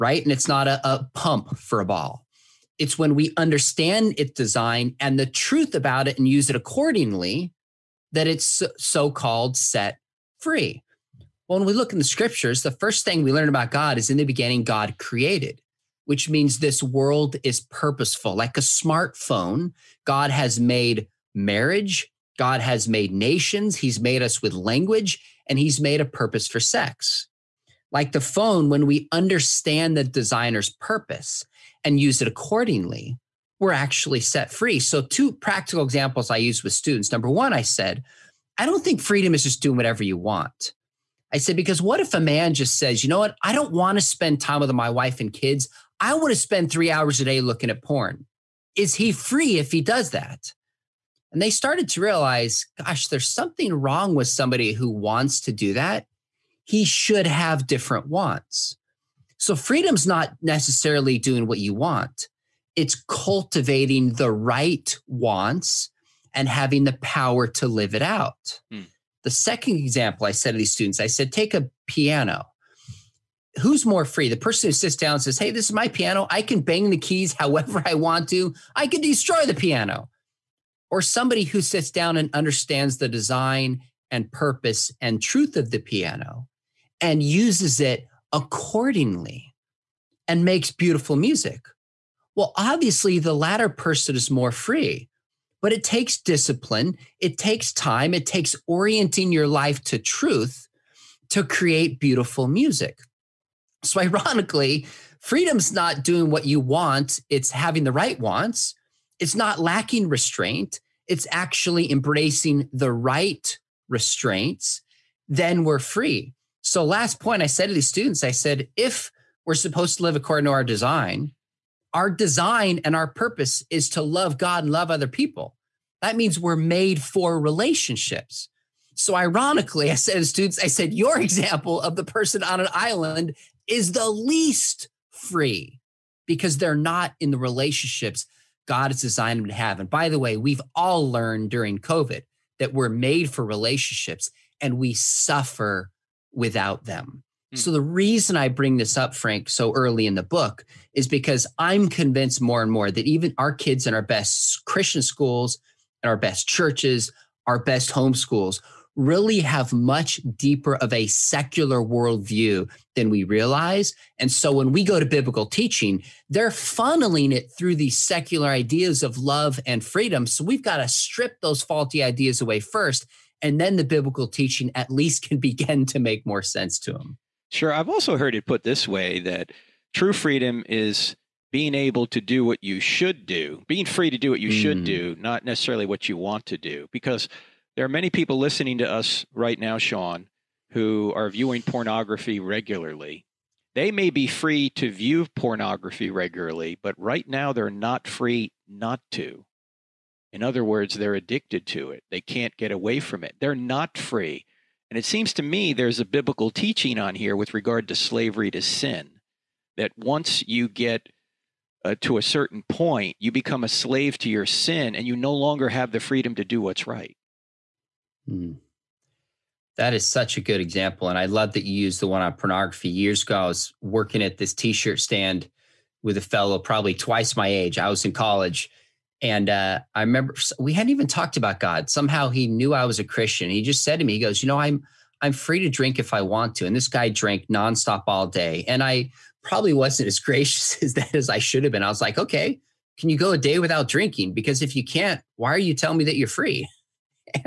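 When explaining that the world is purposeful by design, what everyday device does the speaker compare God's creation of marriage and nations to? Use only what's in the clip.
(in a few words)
smartphone.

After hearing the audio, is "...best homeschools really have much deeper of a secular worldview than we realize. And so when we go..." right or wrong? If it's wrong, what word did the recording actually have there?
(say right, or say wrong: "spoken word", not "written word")
right.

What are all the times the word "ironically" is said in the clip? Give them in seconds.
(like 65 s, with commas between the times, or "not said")
103 s, 129 s.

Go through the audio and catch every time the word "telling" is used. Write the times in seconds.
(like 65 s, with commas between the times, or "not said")
245 s.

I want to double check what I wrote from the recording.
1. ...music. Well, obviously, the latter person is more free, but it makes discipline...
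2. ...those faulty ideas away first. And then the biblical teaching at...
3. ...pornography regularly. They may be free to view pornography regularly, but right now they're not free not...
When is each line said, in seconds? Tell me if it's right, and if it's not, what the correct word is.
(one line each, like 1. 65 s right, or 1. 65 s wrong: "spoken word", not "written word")
1. 91 s wrong: "takes", not "makes"
2. 171 s right
3. 191 s right.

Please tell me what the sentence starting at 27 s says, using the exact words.
Like the phone, when we understand the designer's purpose and use it accordingly, were actually set free.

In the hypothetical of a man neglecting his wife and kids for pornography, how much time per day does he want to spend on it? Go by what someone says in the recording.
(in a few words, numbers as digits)
3 hours.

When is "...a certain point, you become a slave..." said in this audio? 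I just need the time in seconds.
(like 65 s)
212 s.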